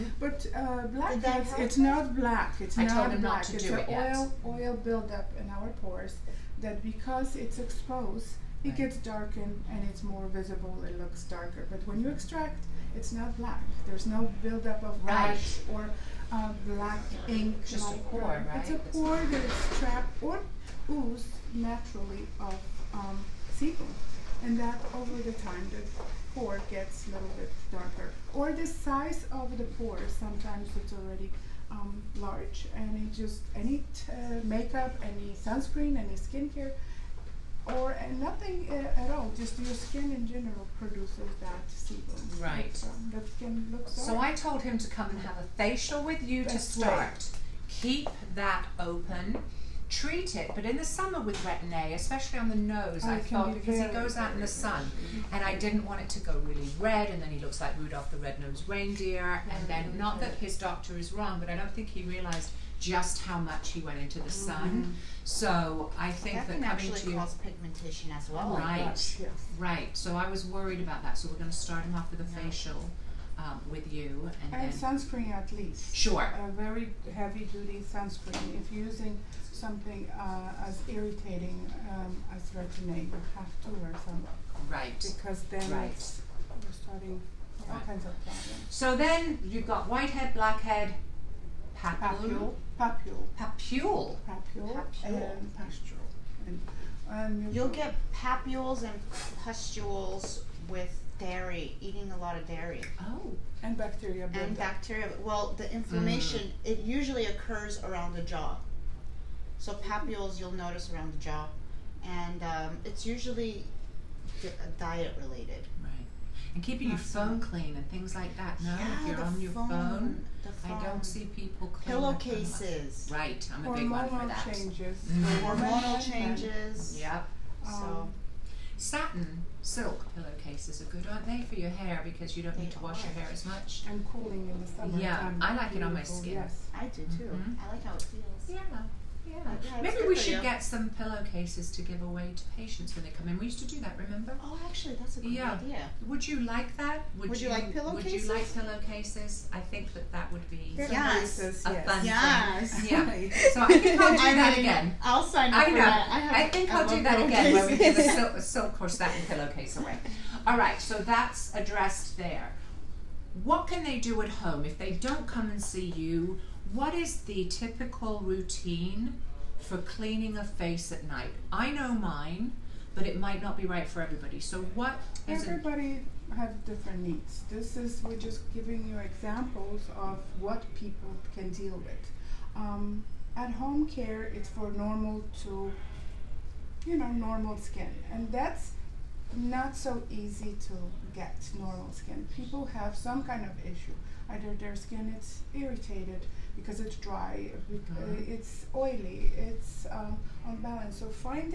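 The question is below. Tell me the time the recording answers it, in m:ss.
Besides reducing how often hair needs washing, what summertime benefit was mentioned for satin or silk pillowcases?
2:14.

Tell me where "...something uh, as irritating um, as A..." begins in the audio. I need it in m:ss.
1:19.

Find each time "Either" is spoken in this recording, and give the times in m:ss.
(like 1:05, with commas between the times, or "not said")
3:14.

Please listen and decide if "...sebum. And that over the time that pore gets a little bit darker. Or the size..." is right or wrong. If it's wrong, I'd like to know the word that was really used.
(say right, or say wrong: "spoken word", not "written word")
right.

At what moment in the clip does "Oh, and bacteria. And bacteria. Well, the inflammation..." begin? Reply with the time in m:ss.
1:43.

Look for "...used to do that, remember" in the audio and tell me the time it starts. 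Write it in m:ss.
2:23.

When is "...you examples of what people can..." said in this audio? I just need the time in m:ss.
2:58.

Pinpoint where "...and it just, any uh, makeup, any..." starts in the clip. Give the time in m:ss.
0:32.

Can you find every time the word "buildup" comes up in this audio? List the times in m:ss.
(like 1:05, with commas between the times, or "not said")
0:04, 0:14.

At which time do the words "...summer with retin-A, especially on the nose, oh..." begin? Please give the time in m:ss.
0:50.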